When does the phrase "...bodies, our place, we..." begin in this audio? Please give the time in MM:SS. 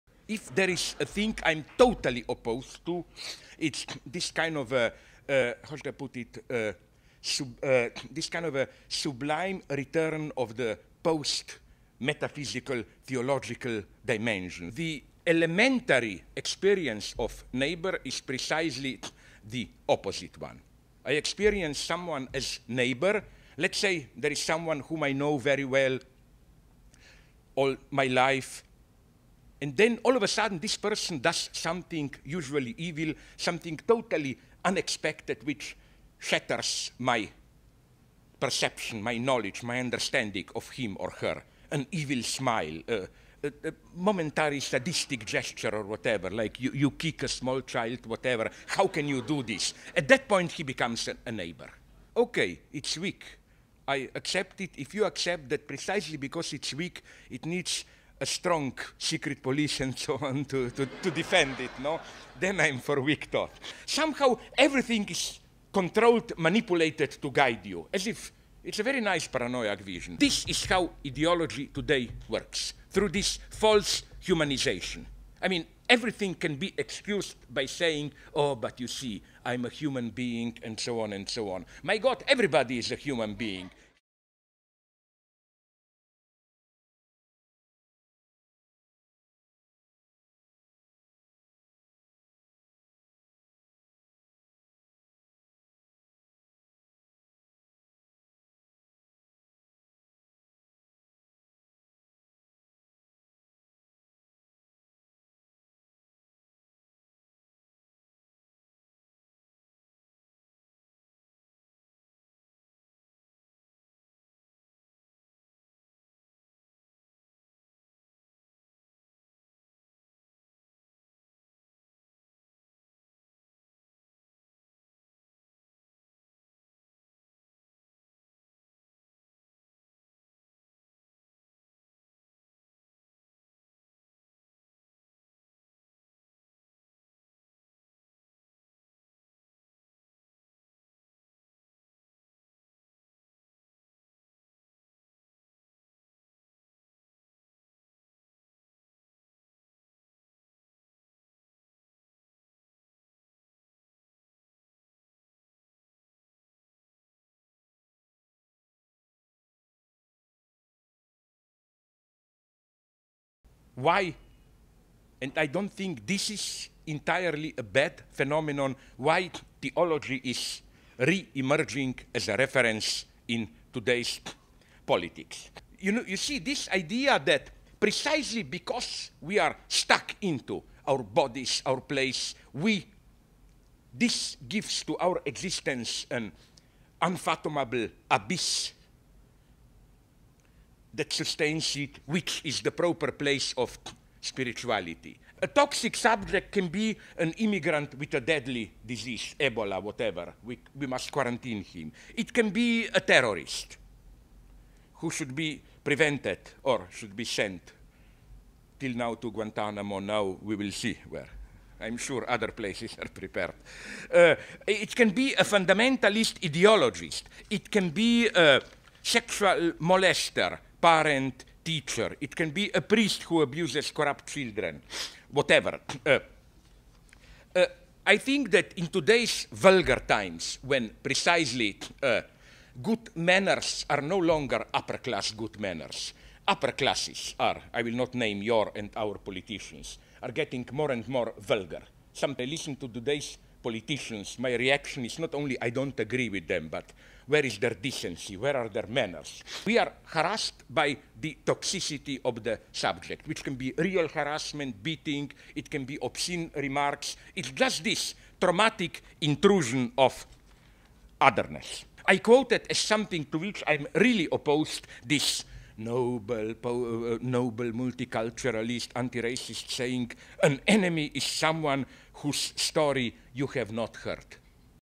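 03:01.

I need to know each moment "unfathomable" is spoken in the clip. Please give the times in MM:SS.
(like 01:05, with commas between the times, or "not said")
03:07.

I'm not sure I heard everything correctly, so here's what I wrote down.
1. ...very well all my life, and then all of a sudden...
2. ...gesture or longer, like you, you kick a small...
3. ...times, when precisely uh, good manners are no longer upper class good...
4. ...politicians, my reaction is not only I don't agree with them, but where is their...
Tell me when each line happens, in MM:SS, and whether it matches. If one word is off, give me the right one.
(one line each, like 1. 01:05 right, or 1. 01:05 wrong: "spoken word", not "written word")
1. 00:25 right
2. 00:45 wrong: "whatever", not "longer"
3. 03:50 right
4. 04:03 right.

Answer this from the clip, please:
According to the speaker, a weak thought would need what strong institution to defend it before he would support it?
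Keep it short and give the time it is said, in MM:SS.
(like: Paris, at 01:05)
secret police, at 00:58.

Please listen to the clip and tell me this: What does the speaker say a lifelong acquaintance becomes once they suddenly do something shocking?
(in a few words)
a neighbor.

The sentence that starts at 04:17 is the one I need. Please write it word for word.
It's just this traumatic intrusion of otherness.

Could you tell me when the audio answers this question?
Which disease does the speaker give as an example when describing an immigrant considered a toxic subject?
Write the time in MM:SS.
03:19.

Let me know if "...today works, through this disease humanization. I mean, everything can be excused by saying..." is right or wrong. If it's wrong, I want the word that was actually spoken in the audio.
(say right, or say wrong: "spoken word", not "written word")
wrong: "false", not "disease".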